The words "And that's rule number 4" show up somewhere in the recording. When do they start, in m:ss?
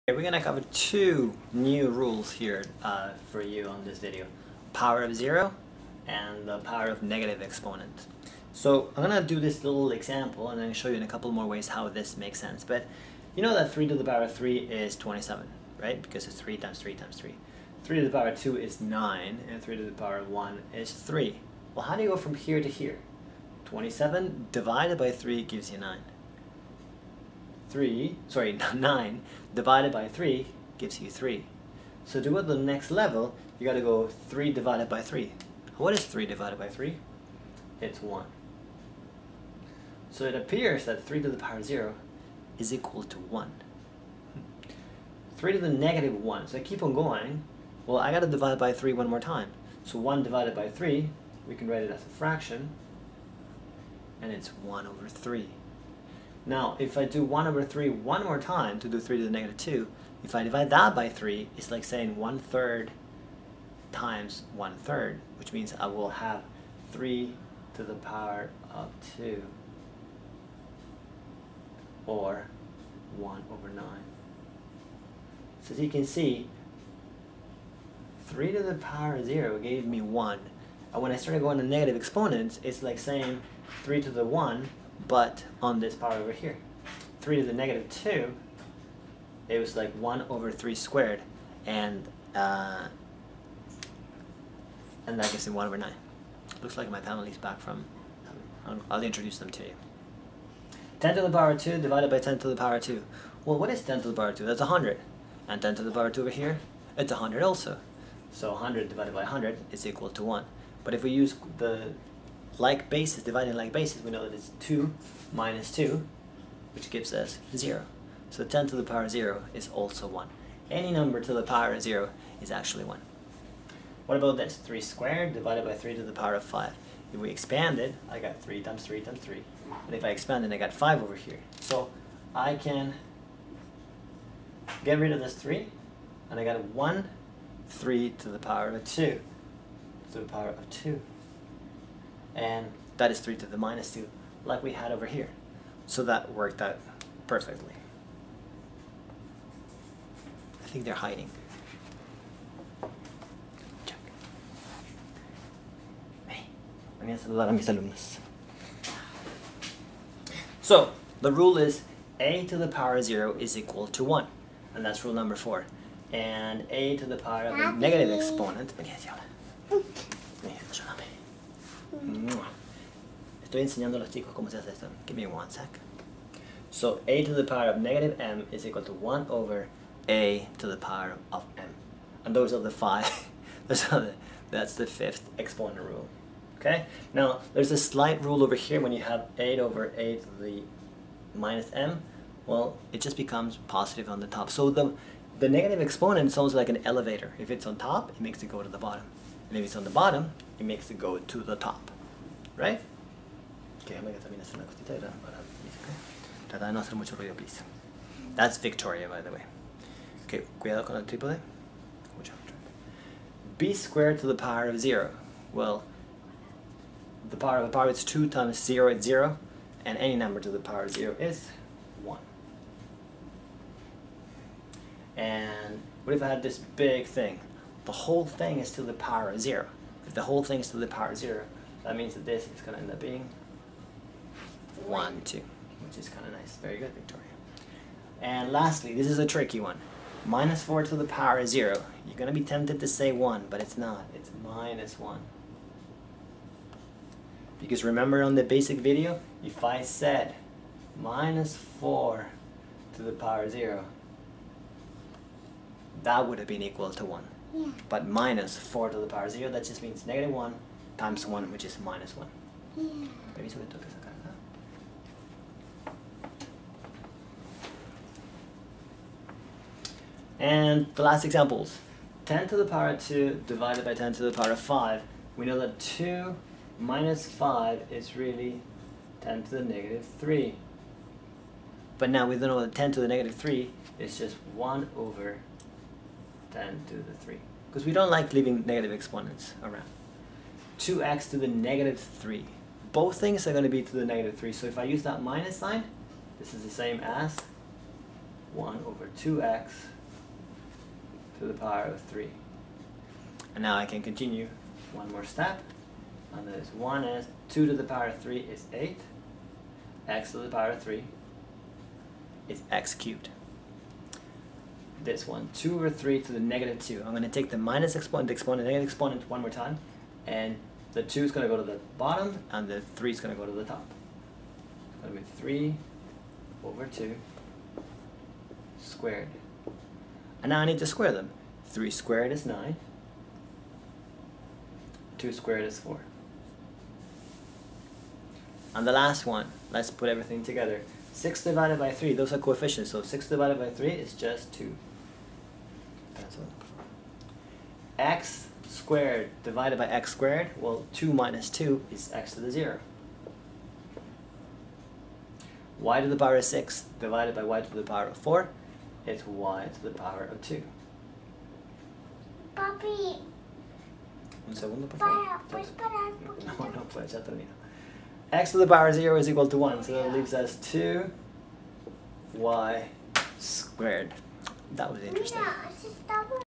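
2:44.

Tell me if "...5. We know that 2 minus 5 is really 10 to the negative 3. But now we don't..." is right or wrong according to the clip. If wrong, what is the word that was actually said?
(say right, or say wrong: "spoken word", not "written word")
right.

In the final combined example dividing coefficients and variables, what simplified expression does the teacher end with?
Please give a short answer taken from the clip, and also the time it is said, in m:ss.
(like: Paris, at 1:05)
2y squared, at 6:10.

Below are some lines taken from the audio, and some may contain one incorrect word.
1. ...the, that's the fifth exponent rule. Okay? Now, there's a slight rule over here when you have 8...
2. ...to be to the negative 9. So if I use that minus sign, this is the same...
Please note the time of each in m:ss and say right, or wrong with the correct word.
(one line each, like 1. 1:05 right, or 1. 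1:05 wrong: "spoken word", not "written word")
1. 3:03 right
2. 4:53 wrong: "3", not "9".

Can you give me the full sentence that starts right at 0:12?
But you know that 3 to the power of 3 is 27, right?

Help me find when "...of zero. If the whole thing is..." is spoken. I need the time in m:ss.
3:49.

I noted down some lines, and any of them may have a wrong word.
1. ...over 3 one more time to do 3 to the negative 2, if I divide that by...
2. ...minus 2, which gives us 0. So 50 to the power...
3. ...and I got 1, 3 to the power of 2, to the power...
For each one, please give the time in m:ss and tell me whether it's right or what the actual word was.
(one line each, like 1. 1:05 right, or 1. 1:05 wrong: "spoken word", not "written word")
1. 0:57 right
2. 1:55 wrong: "10", not "50"
3. 2:16 right.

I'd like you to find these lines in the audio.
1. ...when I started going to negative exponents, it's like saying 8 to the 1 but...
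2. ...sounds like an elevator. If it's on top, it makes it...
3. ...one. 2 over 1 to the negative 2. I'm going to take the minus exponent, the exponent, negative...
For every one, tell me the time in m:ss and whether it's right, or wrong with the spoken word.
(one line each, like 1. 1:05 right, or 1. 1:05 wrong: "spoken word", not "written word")
1. 1:21 wrong: "3", not "8"
2. 3:16 right
3. 5:15 wrong: "3", not "1".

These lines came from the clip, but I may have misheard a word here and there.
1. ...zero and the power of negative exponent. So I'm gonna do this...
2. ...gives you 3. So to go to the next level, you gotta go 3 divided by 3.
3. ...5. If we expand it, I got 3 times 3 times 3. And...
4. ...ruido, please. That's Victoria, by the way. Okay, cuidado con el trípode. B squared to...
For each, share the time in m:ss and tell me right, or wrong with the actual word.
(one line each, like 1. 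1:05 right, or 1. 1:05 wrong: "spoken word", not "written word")
1. 0:05 right
2. 0:30 right
3. 2:06 right
4. 3:27 right.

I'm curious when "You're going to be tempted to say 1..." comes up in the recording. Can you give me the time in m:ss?
4:02.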